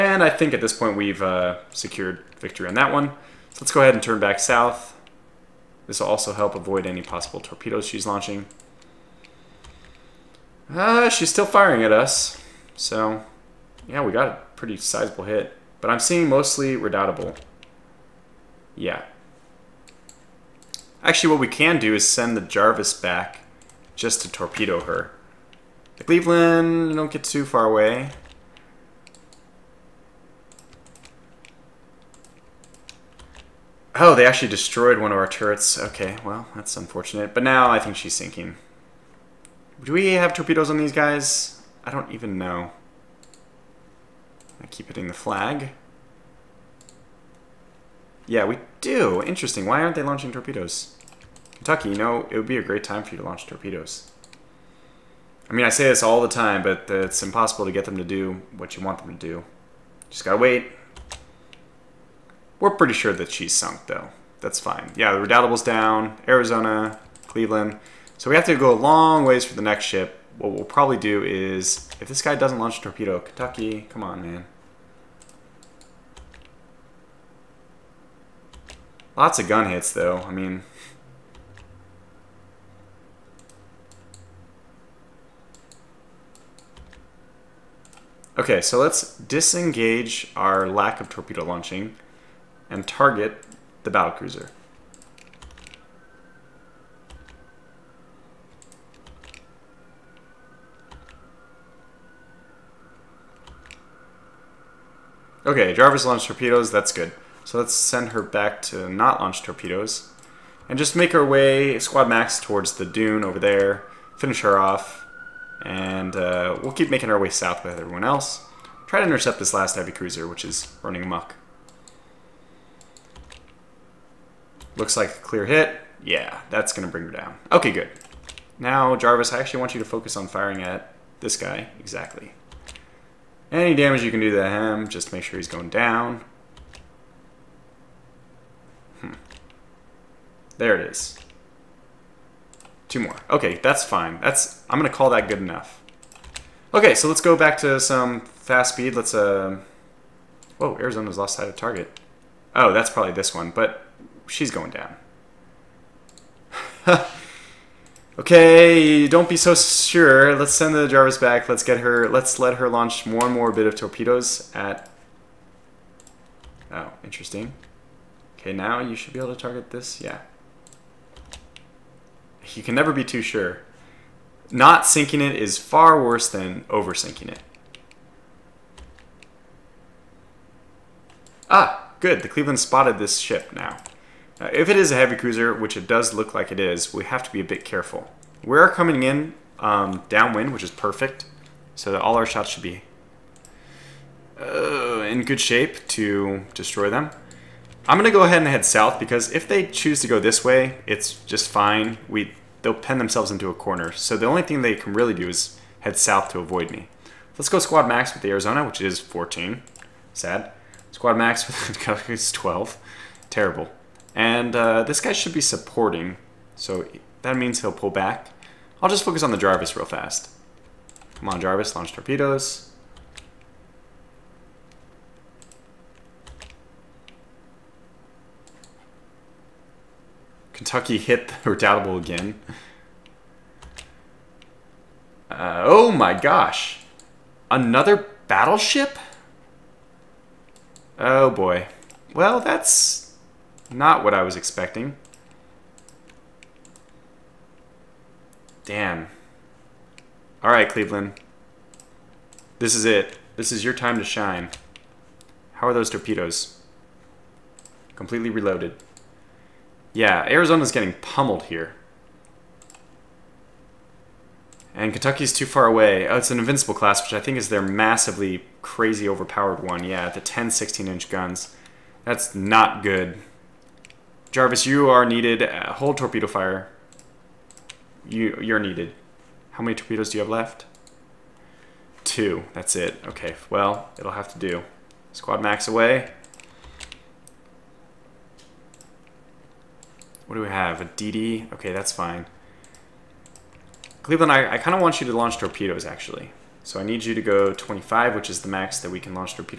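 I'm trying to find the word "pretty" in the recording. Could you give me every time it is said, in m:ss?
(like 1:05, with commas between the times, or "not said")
0:14, 1:02.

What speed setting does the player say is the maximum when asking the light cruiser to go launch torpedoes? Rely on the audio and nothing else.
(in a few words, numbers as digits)
25.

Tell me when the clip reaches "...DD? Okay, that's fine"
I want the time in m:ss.
4:50.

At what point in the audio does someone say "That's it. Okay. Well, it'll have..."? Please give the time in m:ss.
4:42.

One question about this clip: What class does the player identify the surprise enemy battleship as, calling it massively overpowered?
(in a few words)
Invincible.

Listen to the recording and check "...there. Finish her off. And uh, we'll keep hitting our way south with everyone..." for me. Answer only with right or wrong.
wrong.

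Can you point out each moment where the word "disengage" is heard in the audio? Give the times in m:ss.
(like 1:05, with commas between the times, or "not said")
1:29.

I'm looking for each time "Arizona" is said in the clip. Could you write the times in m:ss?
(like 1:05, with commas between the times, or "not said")
1:06, 2:30, 3:28, 4:20.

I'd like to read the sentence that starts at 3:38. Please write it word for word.
I'll just focus on the Jarvis real fast.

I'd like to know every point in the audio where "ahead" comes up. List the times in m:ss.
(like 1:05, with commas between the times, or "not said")
0:03, 3:18.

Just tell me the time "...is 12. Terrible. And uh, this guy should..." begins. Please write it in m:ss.
3:32.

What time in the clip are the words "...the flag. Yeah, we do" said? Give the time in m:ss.
0:45.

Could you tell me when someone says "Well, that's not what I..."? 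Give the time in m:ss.
4:02.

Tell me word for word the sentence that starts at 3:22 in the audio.
We they'll pen themselves into a corner.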